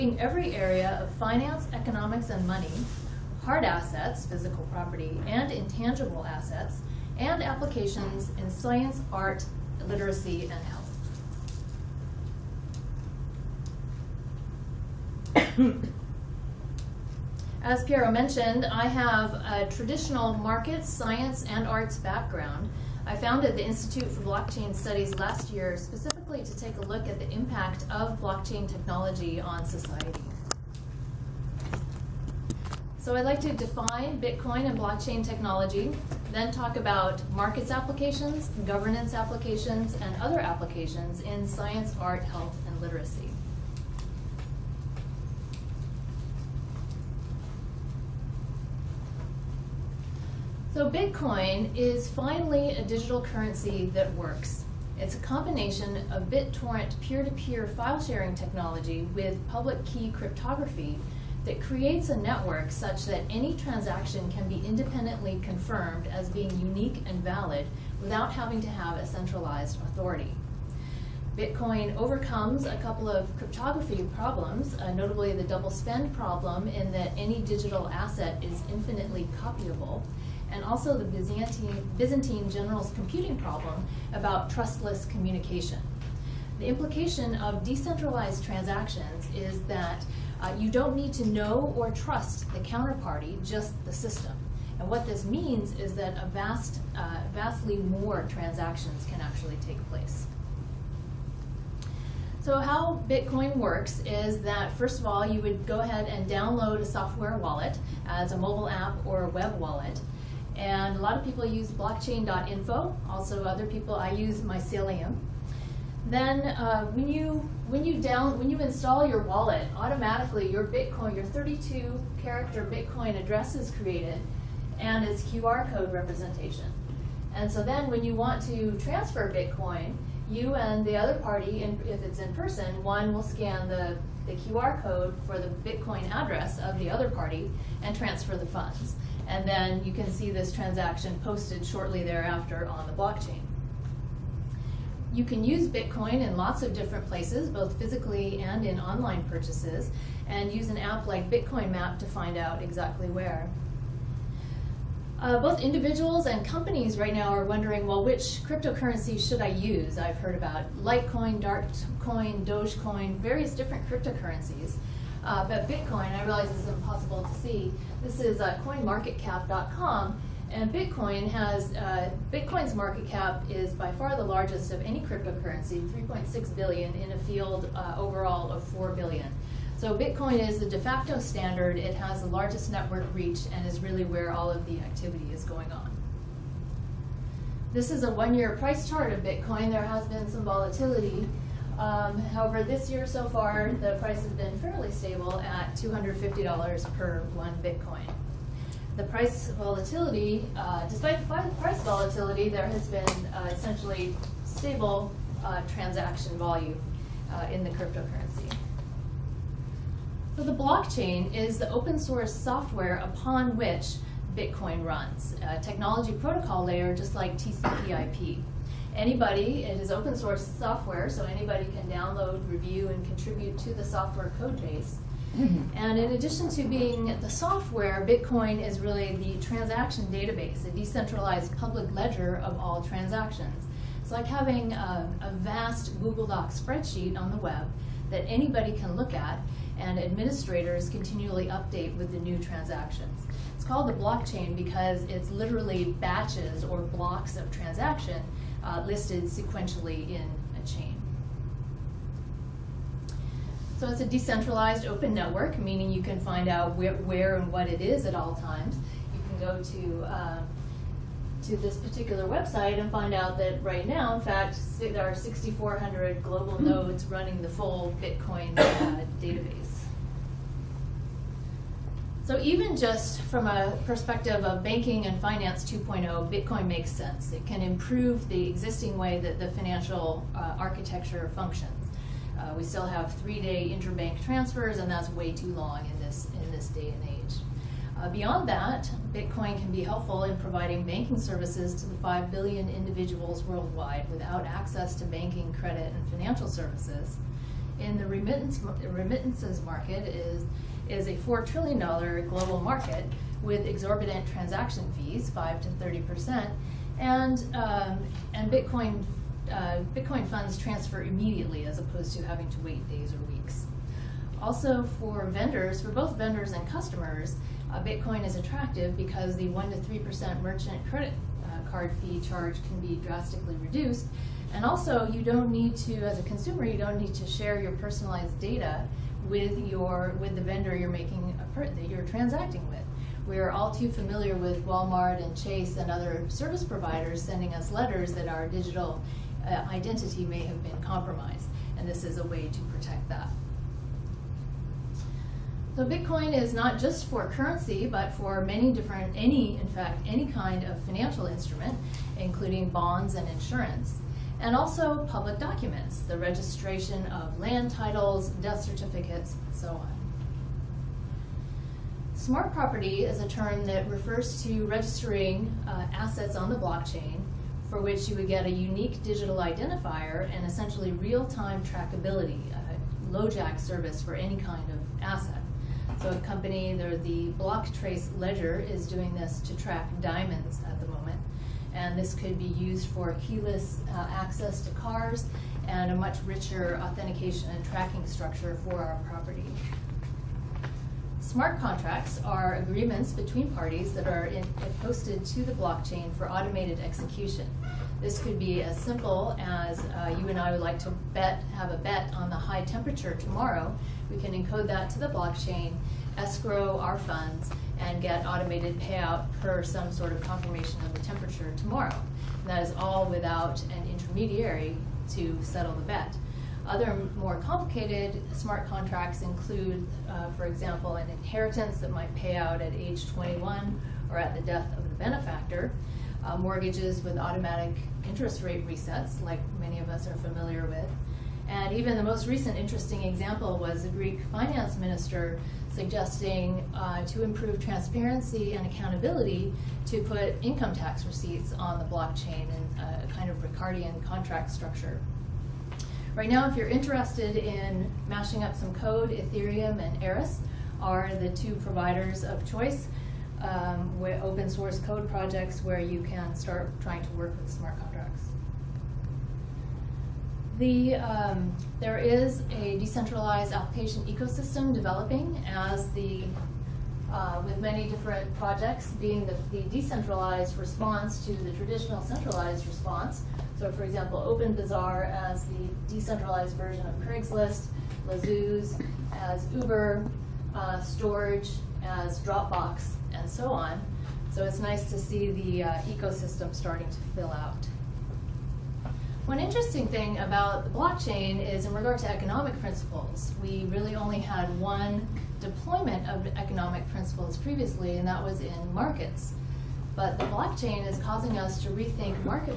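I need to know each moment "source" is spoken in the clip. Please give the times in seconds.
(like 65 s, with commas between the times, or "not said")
211 s, 220 s, 454 s.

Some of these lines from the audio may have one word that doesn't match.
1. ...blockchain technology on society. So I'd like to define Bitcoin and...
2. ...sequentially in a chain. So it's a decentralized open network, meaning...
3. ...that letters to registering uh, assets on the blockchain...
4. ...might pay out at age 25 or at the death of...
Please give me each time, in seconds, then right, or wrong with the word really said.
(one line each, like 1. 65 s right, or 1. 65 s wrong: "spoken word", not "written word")
1. 28 s right
2. 249 s right
3. 363 s wrong: "refers", not "letters"
4. 421 s wrong: "21", not "25".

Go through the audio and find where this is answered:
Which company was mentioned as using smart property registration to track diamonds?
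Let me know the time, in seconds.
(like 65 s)
377 s.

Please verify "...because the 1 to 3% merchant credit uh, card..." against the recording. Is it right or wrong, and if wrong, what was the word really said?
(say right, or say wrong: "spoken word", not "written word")
right.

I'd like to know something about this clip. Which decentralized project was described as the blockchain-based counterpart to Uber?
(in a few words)
Lazooz.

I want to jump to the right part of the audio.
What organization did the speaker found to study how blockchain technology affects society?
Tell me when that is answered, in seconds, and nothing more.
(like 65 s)
23 s.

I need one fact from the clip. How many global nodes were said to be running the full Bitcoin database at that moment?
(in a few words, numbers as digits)
6,400.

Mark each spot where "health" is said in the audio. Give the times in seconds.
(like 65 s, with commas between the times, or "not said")
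15 s, 42 s.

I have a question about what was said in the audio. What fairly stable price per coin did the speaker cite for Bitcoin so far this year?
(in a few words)
$250.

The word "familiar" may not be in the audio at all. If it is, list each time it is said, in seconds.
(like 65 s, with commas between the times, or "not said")
333 s, 430 s.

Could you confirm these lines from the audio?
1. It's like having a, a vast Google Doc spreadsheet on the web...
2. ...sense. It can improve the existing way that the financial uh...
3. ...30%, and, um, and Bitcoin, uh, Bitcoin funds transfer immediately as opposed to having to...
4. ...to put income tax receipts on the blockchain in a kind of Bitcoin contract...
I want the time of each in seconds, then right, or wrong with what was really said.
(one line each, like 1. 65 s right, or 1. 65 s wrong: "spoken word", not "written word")
1. 234 s right
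2. 276 s right
3. 305 s right
4. 439 s wrong: "Ricardian", not "Bitcoin".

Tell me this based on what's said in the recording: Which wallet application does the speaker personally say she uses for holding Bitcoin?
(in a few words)
Mycelium.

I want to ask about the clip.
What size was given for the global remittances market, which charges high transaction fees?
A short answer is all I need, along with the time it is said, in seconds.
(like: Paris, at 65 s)
$4 trillion, at 301 s.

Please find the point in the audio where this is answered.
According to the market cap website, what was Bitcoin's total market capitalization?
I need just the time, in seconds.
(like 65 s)
175 s.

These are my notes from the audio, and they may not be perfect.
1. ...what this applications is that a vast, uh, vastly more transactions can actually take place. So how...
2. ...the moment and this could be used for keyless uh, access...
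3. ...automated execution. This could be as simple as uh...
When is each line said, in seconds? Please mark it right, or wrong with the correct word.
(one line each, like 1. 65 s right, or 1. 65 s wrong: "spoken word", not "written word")
1. 94 s wrong: "means", not "applications"
2. 380 s right
3. 396 s right.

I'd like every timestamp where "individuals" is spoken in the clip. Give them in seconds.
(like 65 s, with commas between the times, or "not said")
155 s, 292 s.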